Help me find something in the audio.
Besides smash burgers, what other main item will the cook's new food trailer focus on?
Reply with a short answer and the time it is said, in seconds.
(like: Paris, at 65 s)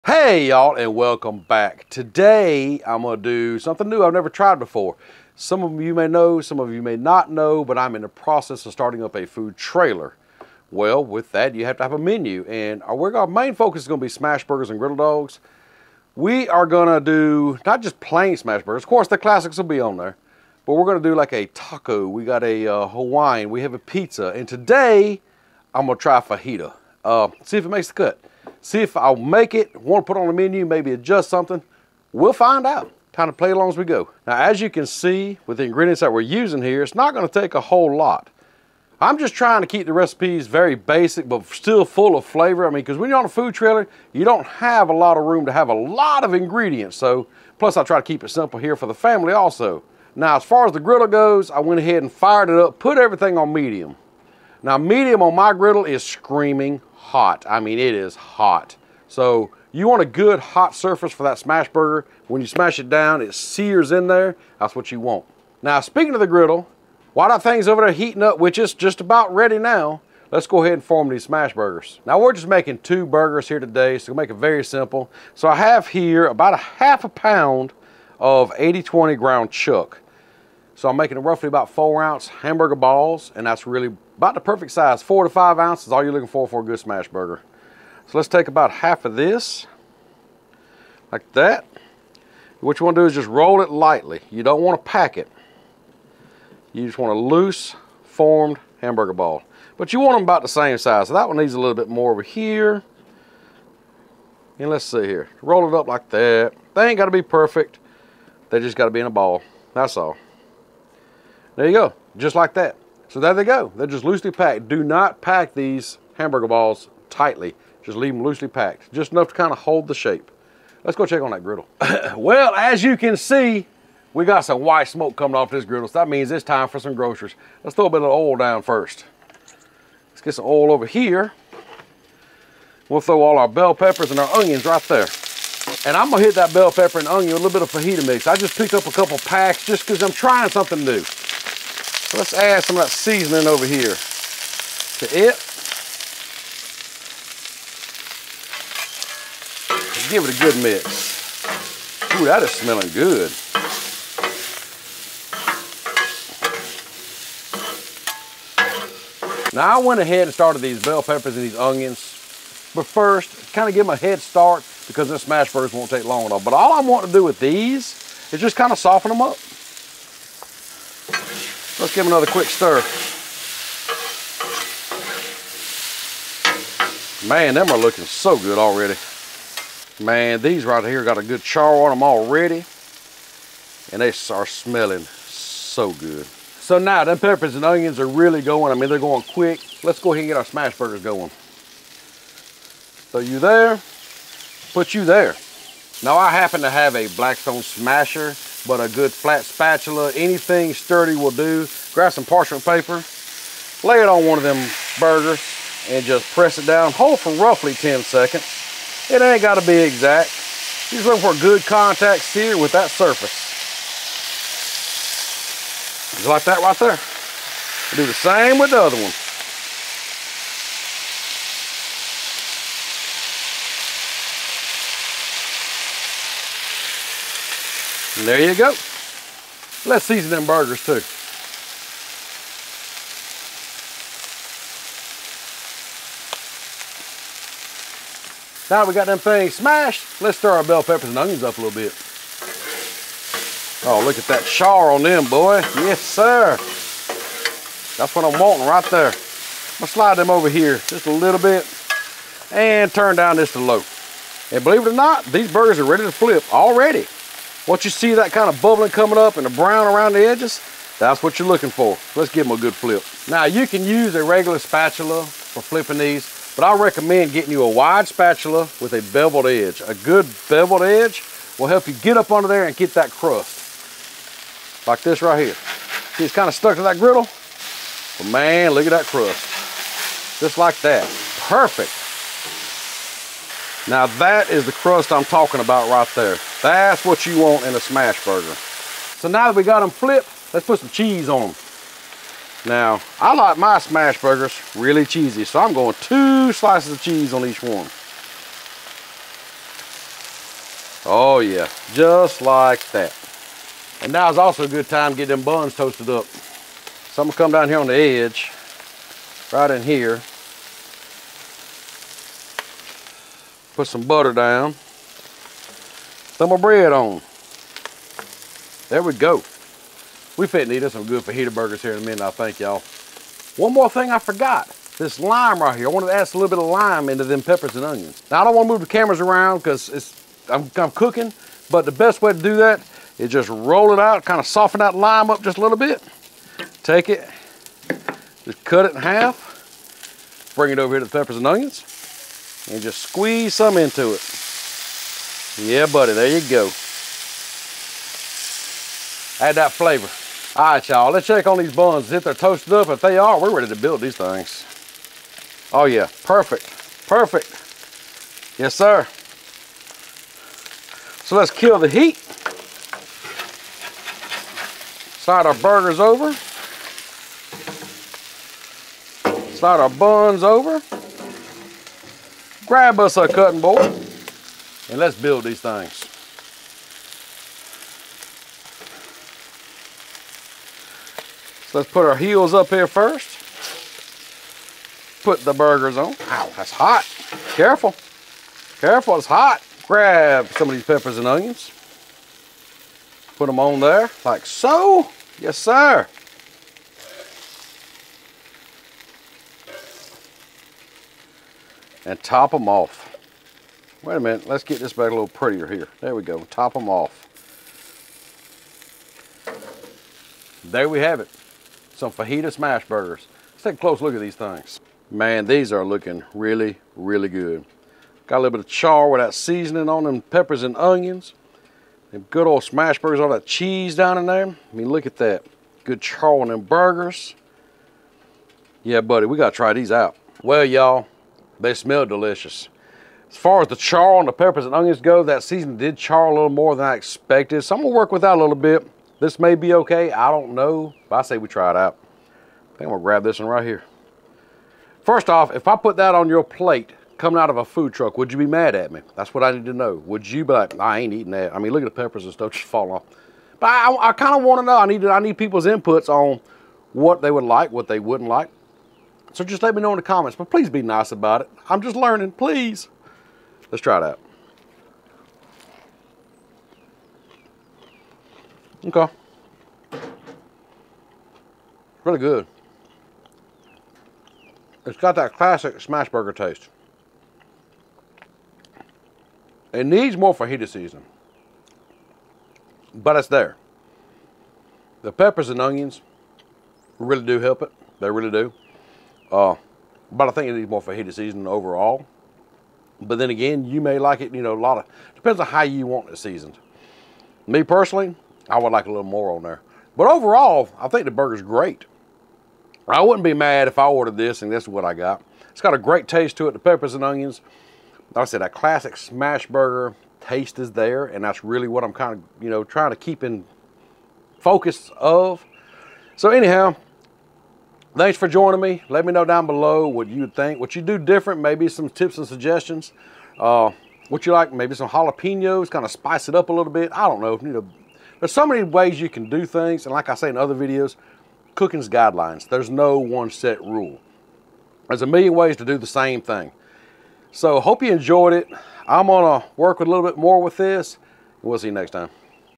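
Griddle dogs, at 14 s.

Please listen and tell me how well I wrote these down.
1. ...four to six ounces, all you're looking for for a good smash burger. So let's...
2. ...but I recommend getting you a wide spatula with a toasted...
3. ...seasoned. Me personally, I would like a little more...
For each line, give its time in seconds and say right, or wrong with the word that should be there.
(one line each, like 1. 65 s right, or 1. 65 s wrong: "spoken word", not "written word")
1. 85 s wrong: "five", not "six"
2. 266 s wrong: "beveled", not "toasted"
3. 496 s right.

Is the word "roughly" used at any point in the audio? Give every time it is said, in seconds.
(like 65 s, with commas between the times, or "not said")
81 s, 207 s.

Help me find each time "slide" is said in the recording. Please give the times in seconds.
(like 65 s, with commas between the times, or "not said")
249 s, 365 s, 369 s.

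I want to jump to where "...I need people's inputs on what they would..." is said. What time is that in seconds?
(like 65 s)
455 s.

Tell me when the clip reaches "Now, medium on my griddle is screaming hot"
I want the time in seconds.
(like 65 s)
54 s.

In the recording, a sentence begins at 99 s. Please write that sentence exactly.
But you want them about the same size.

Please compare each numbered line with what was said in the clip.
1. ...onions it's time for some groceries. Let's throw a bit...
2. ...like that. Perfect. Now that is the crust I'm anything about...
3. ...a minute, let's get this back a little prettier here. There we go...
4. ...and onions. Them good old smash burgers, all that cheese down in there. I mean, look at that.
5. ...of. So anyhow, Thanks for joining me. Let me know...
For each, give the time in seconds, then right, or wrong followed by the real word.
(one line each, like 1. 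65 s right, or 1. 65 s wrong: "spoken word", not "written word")
1. 126 s wrong: "means", not "onions"
2. 280 s wrong: "talking", not "anything"
3. 404 s right
4. 420 s right
5. 514 s right.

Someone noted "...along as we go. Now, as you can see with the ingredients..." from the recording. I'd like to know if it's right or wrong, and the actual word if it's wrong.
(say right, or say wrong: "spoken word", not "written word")
right.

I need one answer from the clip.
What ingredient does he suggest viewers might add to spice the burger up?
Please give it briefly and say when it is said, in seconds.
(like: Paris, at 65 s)
Jalapenos, at 524 s.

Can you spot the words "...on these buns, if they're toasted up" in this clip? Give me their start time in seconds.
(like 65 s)
351 s.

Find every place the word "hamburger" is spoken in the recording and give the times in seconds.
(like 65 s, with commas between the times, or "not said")
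82 s, 98 s, 116 s.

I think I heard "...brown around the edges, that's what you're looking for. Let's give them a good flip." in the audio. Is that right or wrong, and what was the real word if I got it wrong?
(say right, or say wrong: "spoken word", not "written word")
right.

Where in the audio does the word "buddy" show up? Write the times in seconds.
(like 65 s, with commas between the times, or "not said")
345 s, 429 s.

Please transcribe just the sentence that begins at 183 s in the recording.
And they are smelling so good.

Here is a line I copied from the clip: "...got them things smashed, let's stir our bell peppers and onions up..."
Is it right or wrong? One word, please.
right.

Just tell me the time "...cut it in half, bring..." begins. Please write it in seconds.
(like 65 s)
338 s.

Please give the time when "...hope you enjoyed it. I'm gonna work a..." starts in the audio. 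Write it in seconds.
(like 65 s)
537 s.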